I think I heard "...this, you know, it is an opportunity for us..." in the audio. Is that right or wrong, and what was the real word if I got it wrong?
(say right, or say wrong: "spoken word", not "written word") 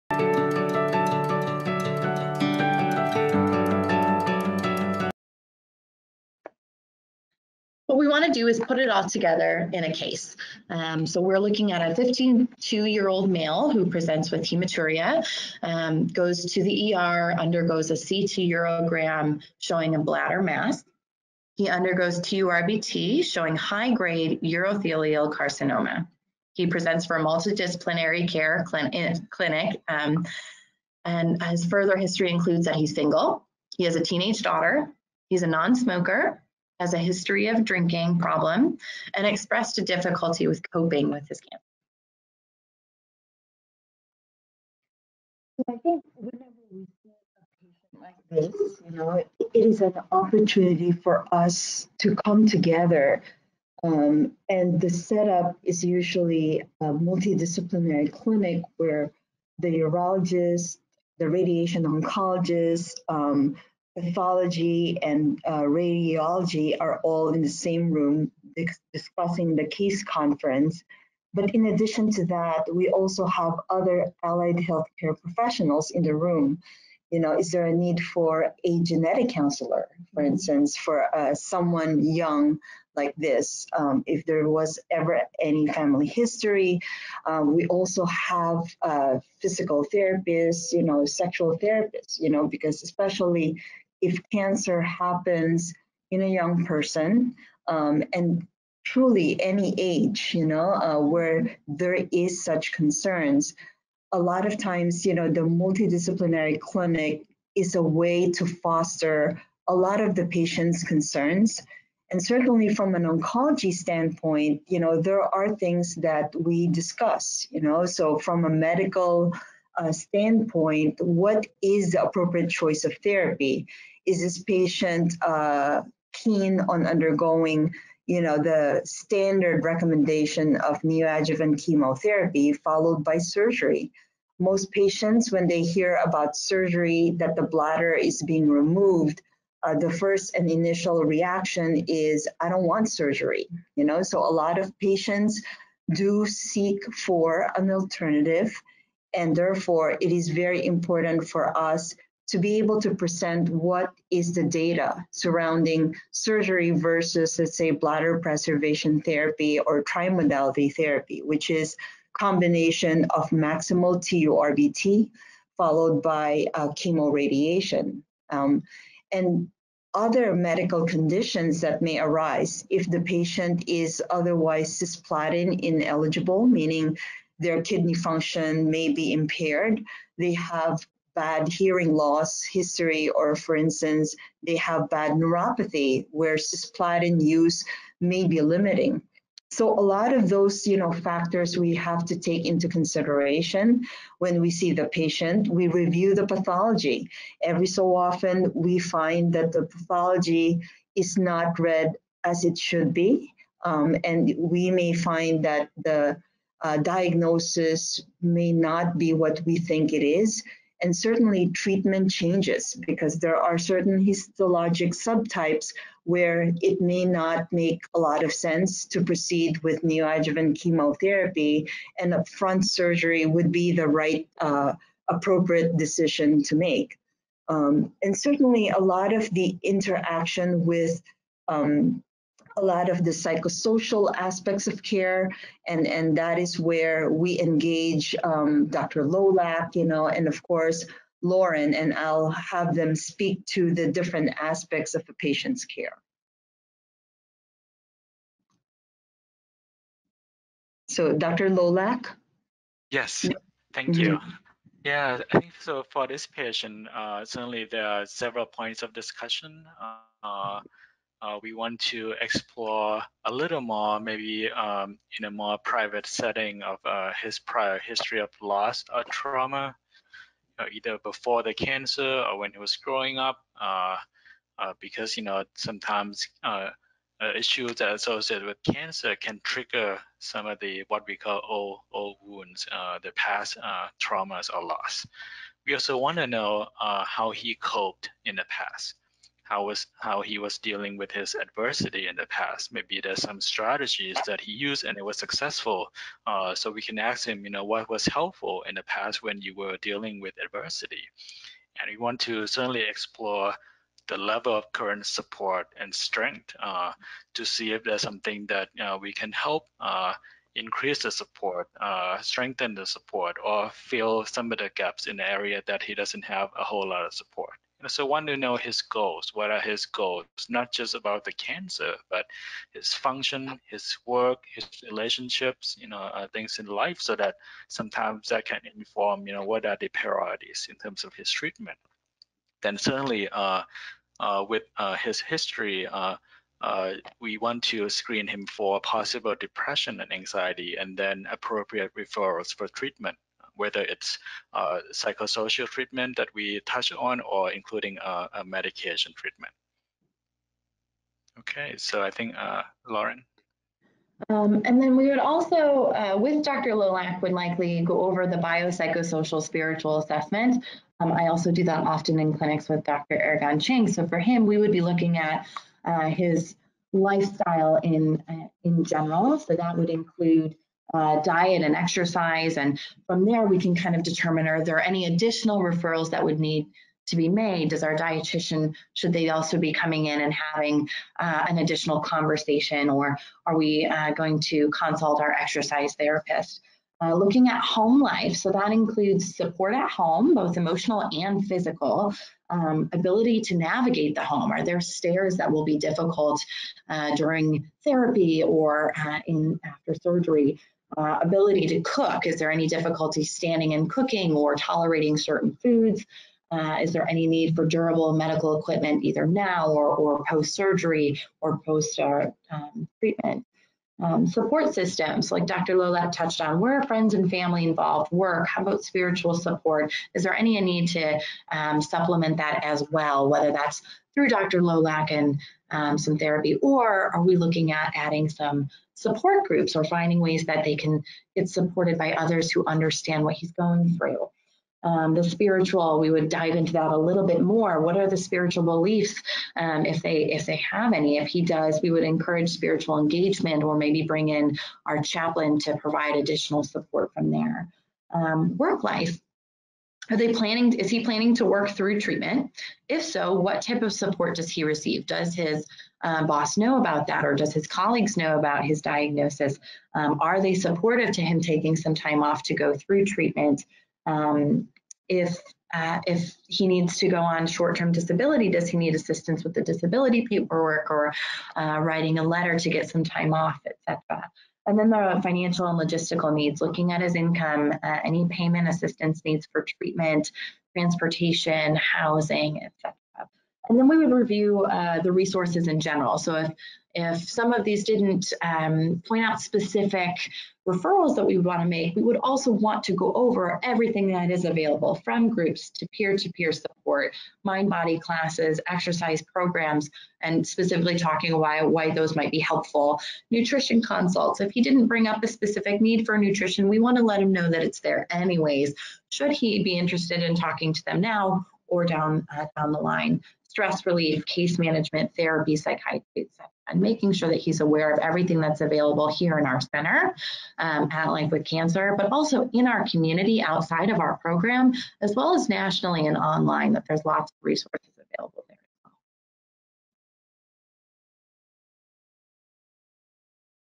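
right.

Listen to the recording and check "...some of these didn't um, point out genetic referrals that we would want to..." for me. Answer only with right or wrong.
wrong.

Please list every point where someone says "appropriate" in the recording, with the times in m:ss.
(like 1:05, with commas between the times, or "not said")
2:02, 3:45, 5:41.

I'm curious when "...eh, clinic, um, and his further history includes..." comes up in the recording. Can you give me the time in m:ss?
0:28.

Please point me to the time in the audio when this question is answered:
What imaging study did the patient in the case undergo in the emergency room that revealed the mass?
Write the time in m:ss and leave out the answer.
0:17.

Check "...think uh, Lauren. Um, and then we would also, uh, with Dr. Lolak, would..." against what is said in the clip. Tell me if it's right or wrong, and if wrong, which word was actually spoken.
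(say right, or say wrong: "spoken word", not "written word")
right.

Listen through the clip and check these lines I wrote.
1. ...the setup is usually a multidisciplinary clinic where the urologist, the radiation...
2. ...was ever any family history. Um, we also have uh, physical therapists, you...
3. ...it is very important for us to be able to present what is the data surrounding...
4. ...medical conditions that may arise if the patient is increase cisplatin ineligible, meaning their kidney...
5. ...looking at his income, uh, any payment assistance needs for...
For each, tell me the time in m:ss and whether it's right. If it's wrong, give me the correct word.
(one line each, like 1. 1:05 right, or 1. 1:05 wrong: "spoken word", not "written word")
1. 0:54 right
2. 1:24 right
3. 2:30 right
4. 2:50 wrong: "otherwise", not "increase"
5. 7:56 right.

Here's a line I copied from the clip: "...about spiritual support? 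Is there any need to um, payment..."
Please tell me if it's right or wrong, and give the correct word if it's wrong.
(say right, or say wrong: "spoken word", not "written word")
wrong: "supplement", not "payment".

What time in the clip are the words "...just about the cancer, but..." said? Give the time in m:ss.
5:20.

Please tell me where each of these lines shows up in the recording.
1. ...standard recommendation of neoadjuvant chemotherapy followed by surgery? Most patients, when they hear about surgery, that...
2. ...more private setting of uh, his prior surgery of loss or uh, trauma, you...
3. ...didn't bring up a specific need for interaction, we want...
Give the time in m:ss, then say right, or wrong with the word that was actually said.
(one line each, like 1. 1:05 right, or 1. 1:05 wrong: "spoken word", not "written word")
1. 2:08 right
2. 4:25 wrong: "history", not "surgery"
3. 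8:24 wrong: "nutrition", not "interaction".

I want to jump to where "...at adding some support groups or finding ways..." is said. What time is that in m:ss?
7:07.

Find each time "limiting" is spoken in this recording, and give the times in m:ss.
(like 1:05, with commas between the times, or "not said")
3:08.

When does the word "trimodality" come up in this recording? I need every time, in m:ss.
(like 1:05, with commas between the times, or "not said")
2:39.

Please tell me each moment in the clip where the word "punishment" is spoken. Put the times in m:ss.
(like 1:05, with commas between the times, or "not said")
not said.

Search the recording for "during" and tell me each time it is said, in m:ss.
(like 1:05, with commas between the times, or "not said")
6:37.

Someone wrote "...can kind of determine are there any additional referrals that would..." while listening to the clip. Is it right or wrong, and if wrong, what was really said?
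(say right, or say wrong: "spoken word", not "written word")
right.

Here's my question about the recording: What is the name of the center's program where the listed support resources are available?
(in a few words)
Life with Cancer.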